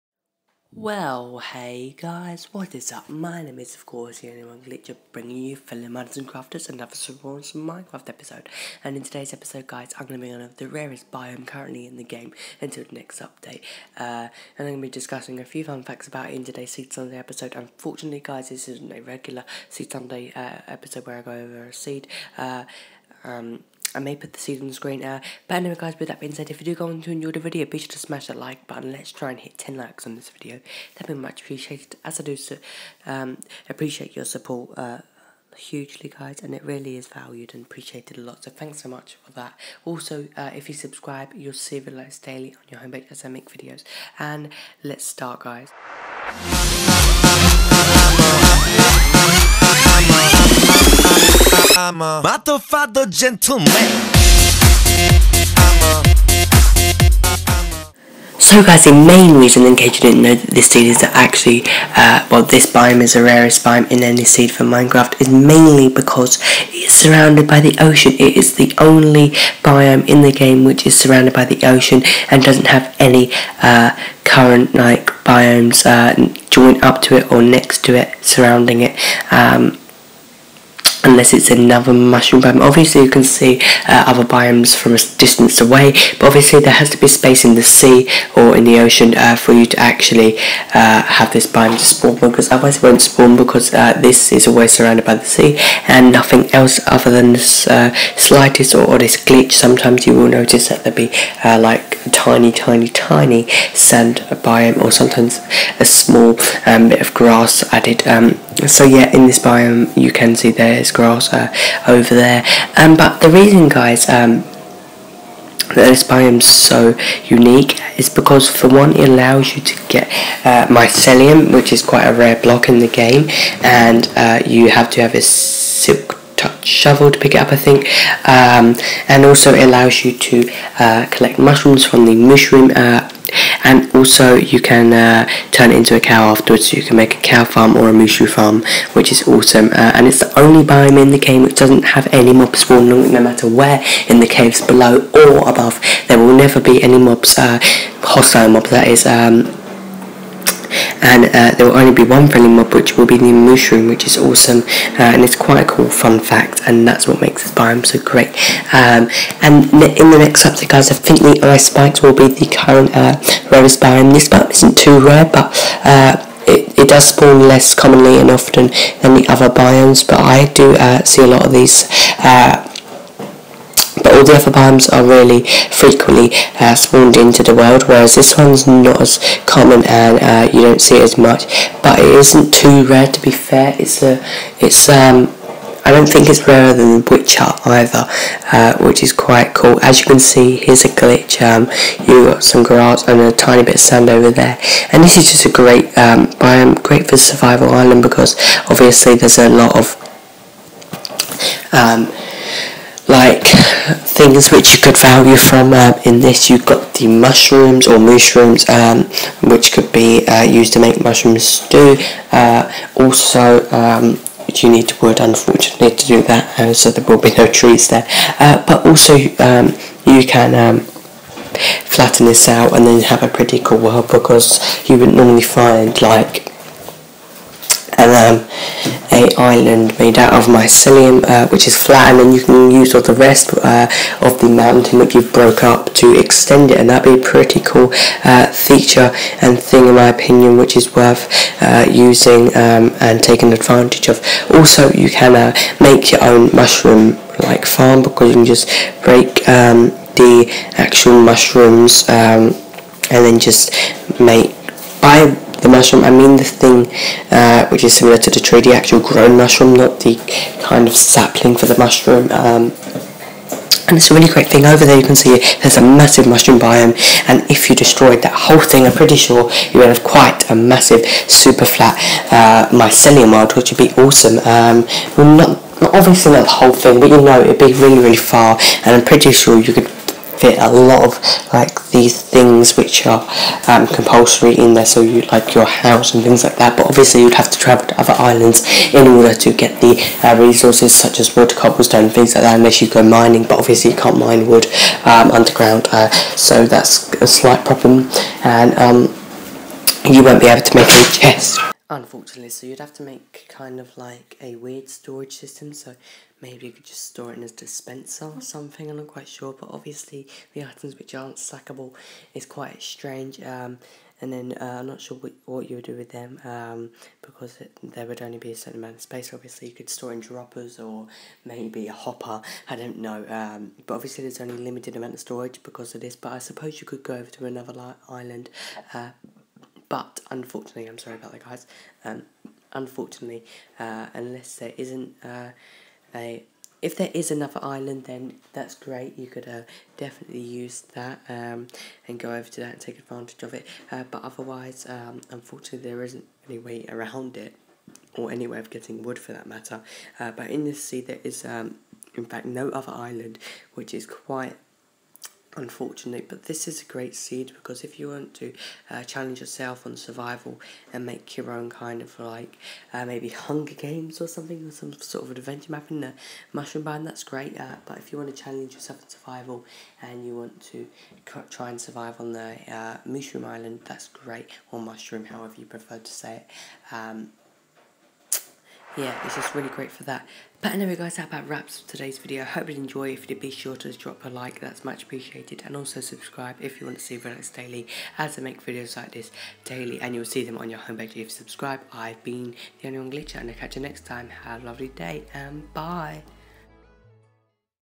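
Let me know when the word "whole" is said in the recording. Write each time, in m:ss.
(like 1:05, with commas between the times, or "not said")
4:28, 4:36.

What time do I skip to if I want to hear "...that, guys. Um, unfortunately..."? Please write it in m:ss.
5:31.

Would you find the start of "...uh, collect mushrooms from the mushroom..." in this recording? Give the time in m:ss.
2:10.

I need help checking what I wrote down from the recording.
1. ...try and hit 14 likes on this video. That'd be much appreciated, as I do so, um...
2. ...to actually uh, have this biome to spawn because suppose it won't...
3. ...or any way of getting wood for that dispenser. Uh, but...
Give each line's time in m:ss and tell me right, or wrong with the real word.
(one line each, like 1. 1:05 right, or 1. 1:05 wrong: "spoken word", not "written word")
1. 0:29 wrong: "10", not "14"
2. 1:29 wrong: "otherwise", not "suppose"
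3. 5:48 wrong: "matter", not "dispenser".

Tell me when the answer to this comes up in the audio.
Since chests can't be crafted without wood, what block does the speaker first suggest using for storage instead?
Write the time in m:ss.
5:07.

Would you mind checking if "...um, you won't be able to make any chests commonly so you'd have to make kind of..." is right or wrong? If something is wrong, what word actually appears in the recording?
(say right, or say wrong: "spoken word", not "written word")
wrong: "unfortunately", not "commonly".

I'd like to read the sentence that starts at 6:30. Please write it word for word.
And you'll see them on your homepage if you subscribe.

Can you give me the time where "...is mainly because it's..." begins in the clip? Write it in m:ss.
1:05.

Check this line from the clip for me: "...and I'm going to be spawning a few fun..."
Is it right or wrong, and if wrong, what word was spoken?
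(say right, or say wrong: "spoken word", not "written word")
wrong: "discussing", not "spawning".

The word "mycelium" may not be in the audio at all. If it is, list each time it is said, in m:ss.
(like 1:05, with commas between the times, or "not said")
2:00, 3:50, 4:32.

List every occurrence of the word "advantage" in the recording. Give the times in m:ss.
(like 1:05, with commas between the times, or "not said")
4:03, 5:42.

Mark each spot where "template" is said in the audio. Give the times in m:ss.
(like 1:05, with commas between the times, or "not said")
not said.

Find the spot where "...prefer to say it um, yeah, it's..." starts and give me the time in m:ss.
6:15.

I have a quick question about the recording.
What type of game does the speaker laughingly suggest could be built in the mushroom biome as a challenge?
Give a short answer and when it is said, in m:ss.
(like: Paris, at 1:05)
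Hunger games, at 6:03.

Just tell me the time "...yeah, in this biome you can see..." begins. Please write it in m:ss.
1:48.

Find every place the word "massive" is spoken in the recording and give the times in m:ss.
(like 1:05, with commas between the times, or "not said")
4:25, 4:30.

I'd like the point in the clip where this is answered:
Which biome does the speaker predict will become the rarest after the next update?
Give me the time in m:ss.
2:41.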